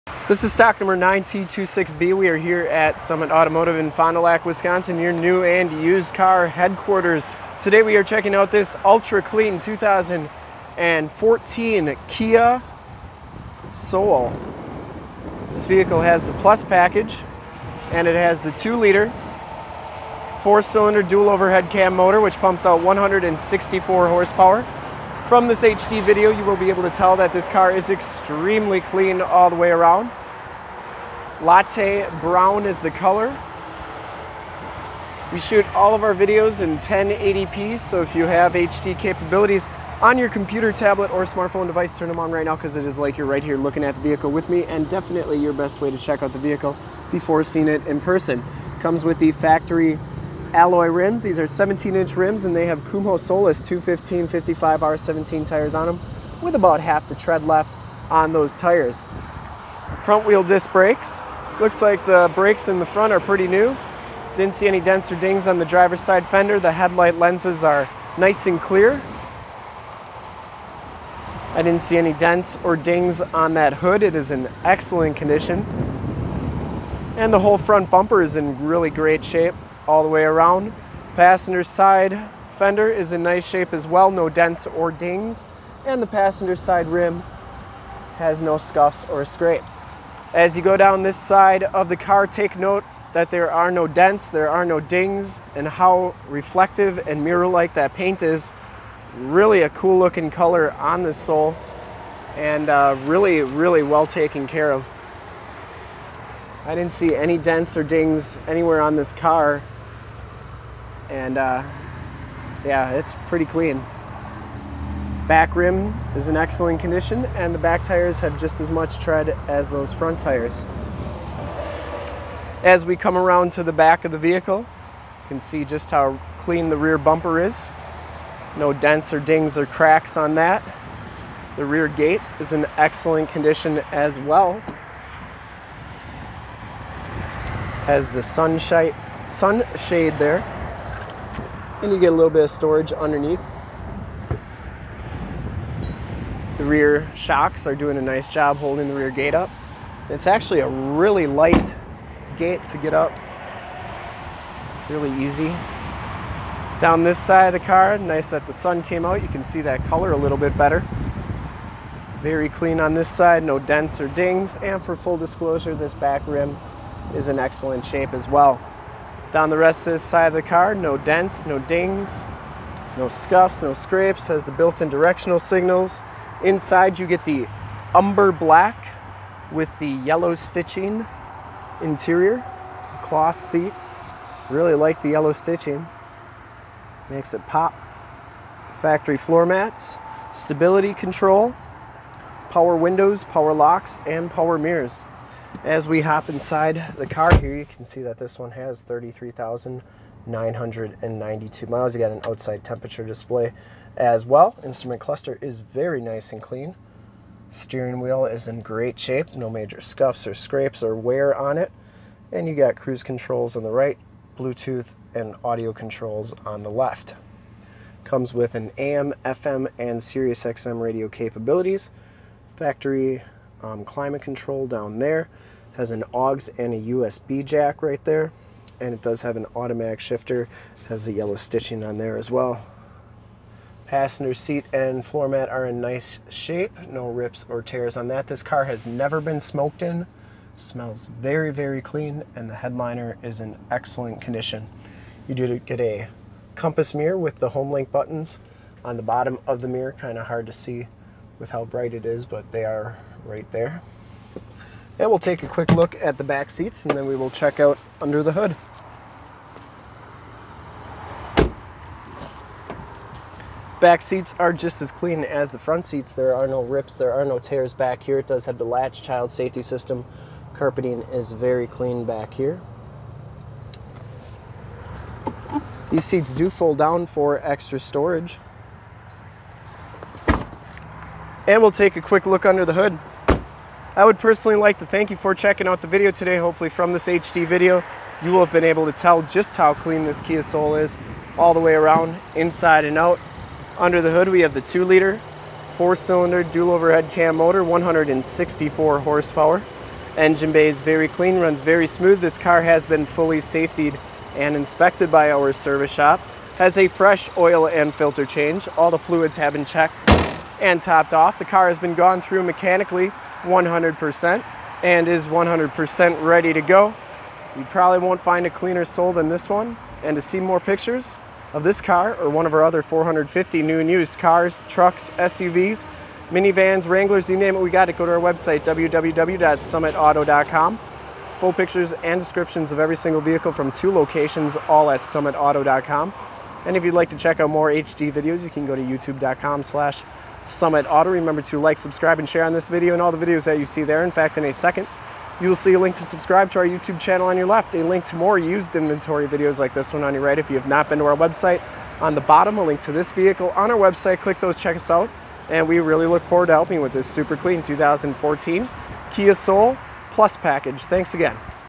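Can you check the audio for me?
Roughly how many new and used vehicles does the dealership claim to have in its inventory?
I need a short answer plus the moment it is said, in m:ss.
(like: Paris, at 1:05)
450, at 5:22.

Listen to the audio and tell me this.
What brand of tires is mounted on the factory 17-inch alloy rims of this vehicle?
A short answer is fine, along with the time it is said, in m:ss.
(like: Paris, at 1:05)
Kumho Solus, at 0:52.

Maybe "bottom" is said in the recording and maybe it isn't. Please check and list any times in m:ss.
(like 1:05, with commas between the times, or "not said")
4:09, 5:52.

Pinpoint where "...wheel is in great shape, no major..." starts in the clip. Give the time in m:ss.
3:27.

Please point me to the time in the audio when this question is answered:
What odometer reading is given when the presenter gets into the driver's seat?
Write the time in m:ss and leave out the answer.
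3:18.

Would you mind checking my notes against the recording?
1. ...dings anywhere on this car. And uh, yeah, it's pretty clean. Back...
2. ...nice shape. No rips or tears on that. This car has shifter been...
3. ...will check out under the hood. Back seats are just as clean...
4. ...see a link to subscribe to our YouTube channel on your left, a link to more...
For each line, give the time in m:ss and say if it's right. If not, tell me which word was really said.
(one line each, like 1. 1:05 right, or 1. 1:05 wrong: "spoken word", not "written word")
1. 1:47 right
2. 3:55 wrong: "never", not "shifter"
3. 4:17 right
4. 5:45 right.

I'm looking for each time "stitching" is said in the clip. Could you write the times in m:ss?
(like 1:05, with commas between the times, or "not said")
3:00, 3:05, 3:51.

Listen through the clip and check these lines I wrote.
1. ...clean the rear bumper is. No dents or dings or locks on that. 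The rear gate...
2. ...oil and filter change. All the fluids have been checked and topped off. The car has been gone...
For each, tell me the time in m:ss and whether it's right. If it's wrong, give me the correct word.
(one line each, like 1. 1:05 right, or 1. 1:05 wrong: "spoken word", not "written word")
1. 2:06 wrong: "cracks", not "locks"
2. 5:07 right.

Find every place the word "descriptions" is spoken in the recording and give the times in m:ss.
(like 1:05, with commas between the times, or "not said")
5:32.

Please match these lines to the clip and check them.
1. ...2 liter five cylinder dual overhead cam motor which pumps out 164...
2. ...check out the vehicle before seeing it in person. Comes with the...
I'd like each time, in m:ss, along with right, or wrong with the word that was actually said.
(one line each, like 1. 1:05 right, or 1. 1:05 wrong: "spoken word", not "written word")
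1. 0:18 wrong: "four", not "five"
2. 0:45 right.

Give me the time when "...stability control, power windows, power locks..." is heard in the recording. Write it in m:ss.
3:10.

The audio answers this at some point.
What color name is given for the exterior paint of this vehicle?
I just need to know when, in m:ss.
0:31.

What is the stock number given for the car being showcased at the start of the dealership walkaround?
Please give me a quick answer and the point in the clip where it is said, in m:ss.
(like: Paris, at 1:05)
9T26B, at 0:00.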